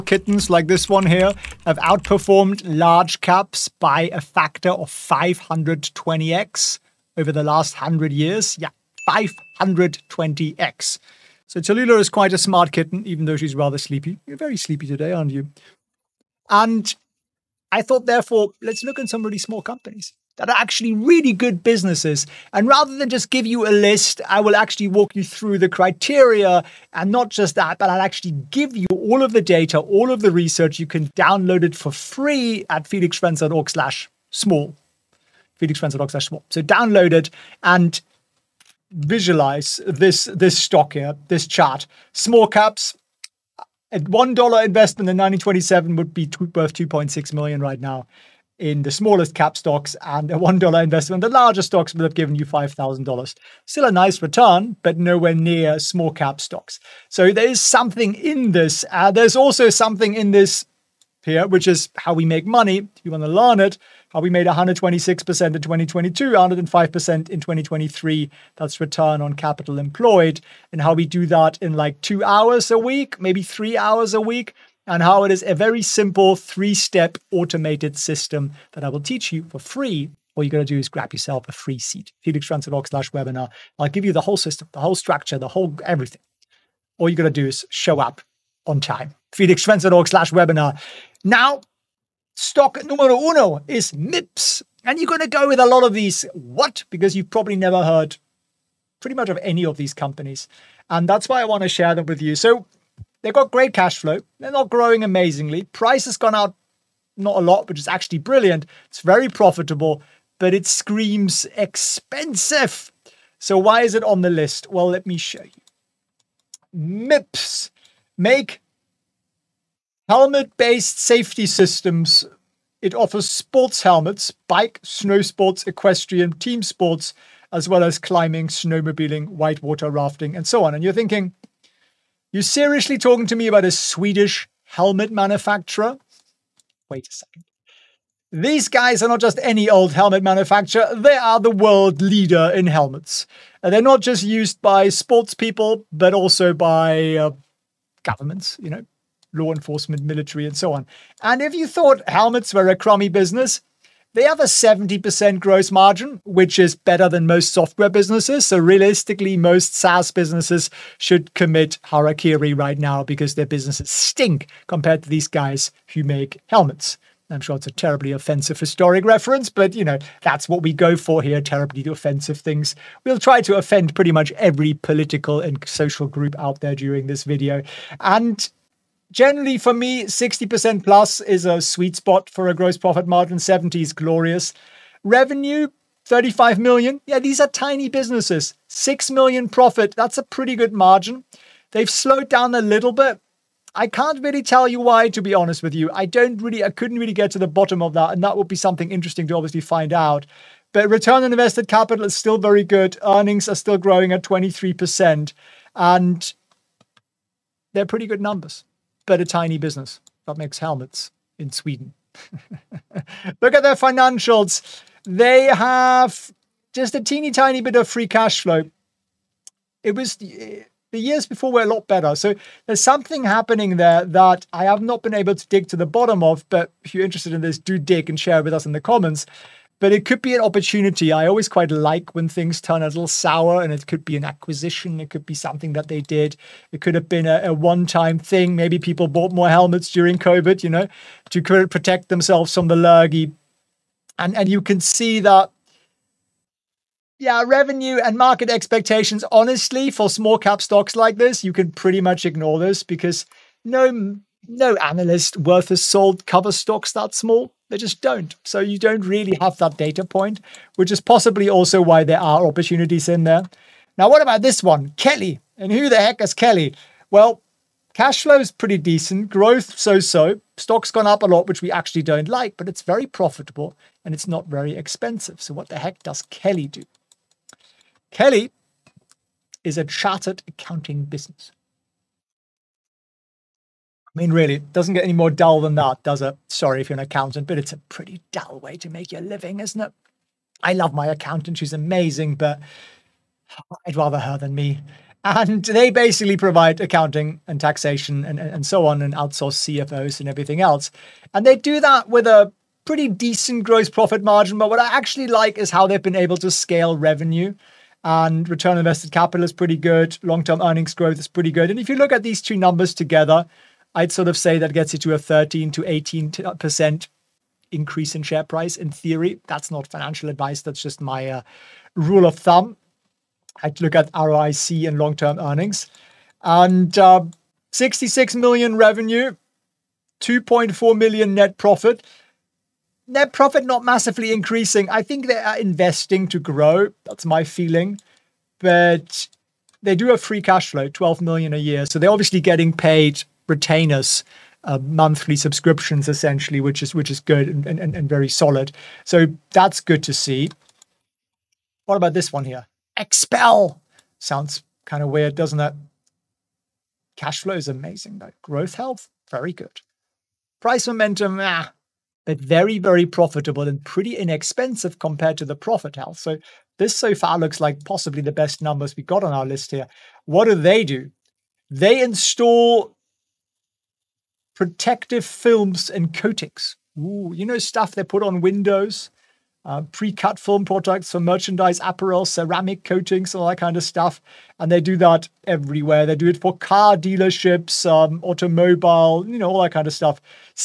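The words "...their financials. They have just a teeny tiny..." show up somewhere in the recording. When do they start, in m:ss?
3:33.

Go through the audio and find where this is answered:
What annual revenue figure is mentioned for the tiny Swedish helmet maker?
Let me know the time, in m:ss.
3:06.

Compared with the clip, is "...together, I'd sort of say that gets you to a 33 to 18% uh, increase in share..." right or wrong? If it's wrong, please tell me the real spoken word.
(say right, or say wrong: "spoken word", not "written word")
wrong: "13", not "33".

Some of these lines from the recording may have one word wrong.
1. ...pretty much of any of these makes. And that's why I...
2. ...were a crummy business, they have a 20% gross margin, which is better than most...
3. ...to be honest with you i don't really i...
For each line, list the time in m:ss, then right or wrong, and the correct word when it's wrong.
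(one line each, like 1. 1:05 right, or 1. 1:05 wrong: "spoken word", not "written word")
1. 1:39 wrong: "companies", not "makes"
2. 2:32 wrong: "70", not "20"
3. 3:15 right.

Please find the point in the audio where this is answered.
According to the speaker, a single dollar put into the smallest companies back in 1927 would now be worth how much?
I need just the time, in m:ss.
0:46.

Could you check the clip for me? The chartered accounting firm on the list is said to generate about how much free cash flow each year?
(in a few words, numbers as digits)
12 million.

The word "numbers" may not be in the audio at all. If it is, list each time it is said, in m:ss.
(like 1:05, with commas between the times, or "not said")
3:28, 5:12, 6:08.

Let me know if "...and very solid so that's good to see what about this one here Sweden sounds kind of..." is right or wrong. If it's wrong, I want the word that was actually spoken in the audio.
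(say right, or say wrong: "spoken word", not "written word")
wrong: "XPEL", not "Sweden".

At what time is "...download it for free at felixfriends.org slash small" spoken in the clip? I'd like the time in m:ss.
0:31.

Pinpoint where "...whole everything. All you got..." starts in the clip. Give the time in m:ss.
1:25.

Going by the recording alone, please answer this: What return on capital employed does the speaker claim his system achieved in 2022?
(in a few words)
126%.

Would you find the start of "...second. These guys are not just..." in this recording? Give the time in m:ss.
2:17.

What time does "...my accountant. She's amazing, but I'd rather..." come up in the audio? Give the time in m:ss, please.
4:50.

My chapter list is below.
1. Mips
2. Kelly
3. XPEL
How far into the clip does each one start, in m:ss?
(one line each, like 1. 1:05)
1. 1:34
2. 4:24
3. 5:52.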